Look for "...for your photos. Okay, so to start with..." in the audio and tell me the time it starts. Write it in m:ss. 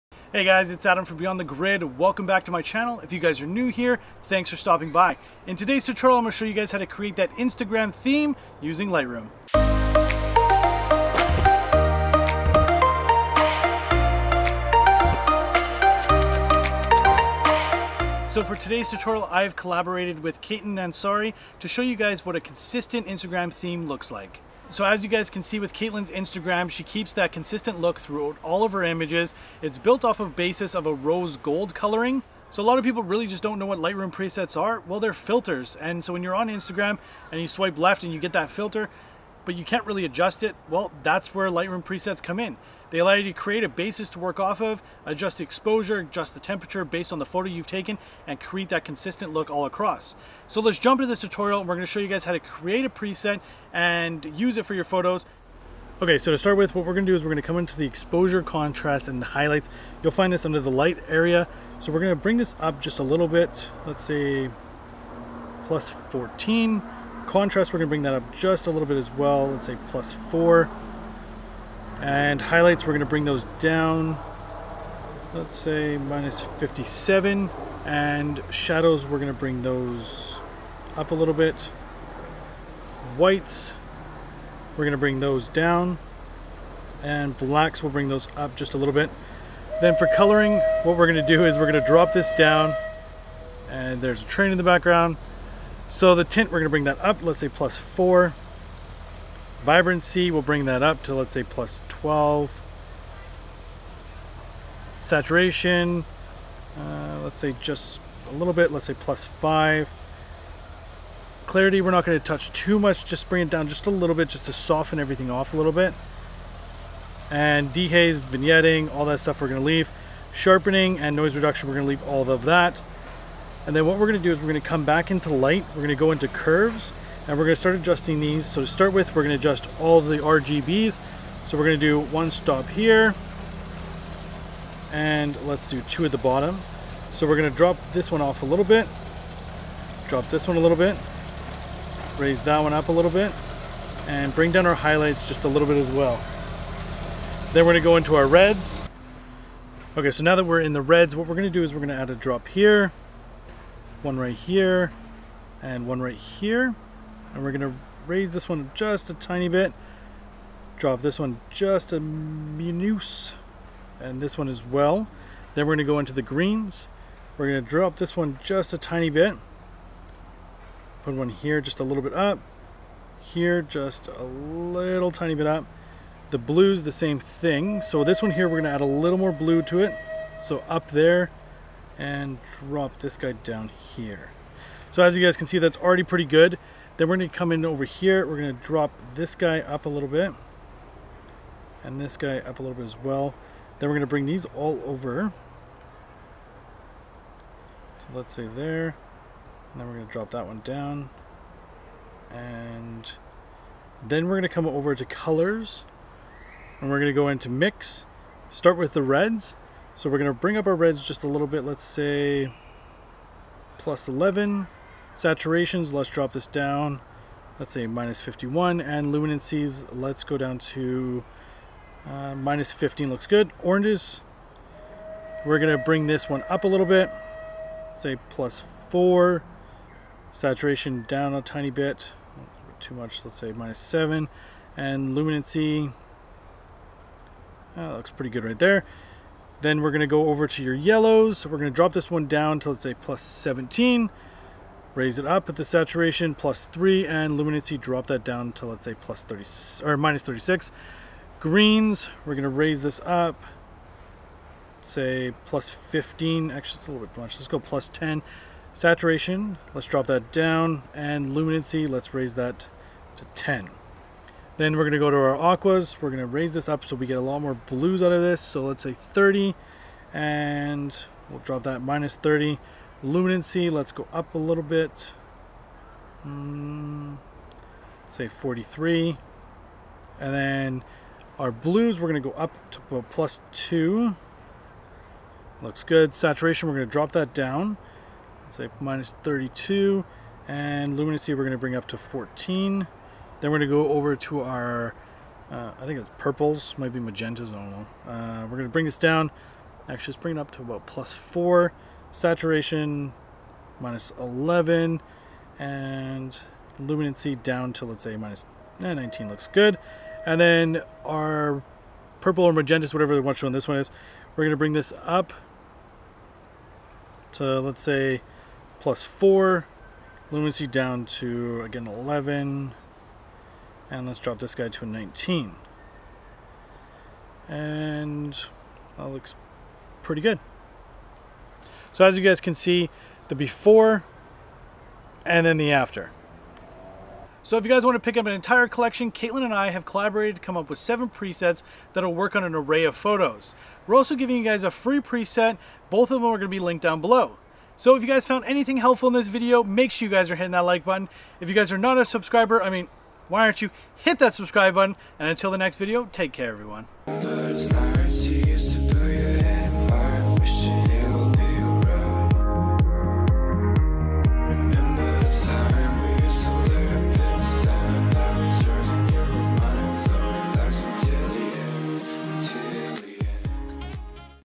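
0:54.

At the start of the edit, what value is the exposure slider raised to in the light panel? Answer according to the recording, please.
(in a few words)
+14.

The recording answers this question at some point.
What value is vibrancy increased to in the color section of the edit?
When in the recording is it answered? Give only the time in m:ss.
1:41.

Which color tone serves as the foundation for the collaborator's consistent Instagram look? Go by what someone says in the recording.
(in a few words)
Rose gold.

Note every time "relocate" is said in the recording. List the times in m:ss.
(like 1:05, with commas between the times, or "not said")
not said.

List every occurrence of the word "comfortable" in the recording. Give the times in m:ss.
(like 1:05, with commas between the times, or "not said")
not said.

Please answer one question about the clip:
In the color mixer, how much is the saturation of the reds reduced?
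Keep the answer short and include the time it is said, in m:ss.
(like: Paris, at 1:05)
-51, at 3:37.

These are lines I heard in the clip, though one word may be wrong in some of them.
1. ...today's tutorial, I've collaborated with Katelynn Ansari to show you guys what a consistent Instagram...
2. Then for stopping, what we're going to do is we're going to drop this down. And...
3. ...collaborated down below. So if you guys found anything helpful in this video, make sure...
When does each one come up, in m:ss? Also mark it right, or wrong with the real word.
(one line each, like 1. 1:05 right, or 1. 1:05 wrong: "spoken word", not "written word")
1. 0:18 right
2. 1:29 wrong: "coloring", not "stopping"
3. 5:46 wrong: "linked", not "collaborated".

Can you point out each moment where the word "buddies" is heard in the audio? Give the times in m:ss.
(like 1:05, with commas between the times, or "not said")
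not said.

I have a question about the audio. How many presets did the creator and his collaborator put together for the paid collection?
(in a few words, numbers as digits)
7.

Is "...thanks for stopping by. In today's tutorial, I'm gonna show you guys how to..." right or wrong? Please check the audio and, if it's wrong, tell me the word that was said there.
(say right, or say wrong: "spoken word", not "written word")
right.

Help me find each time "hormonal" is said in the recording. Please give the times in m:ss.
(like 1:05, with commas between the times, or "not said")
not said.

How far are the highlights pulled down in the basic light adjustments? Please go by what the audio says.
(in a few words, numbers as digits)
-57.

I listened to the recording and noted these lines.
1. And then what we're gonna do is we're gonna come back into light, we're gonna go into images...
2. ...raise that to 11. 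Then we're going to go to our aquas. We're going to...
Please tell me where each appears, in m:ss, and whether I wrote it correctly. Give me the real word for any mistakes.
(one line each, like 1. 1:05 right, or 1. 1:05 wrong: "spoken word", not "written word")
1. 2:03 wrong: "curves", not "images"
2. 4:22 wrong: "10", not "11".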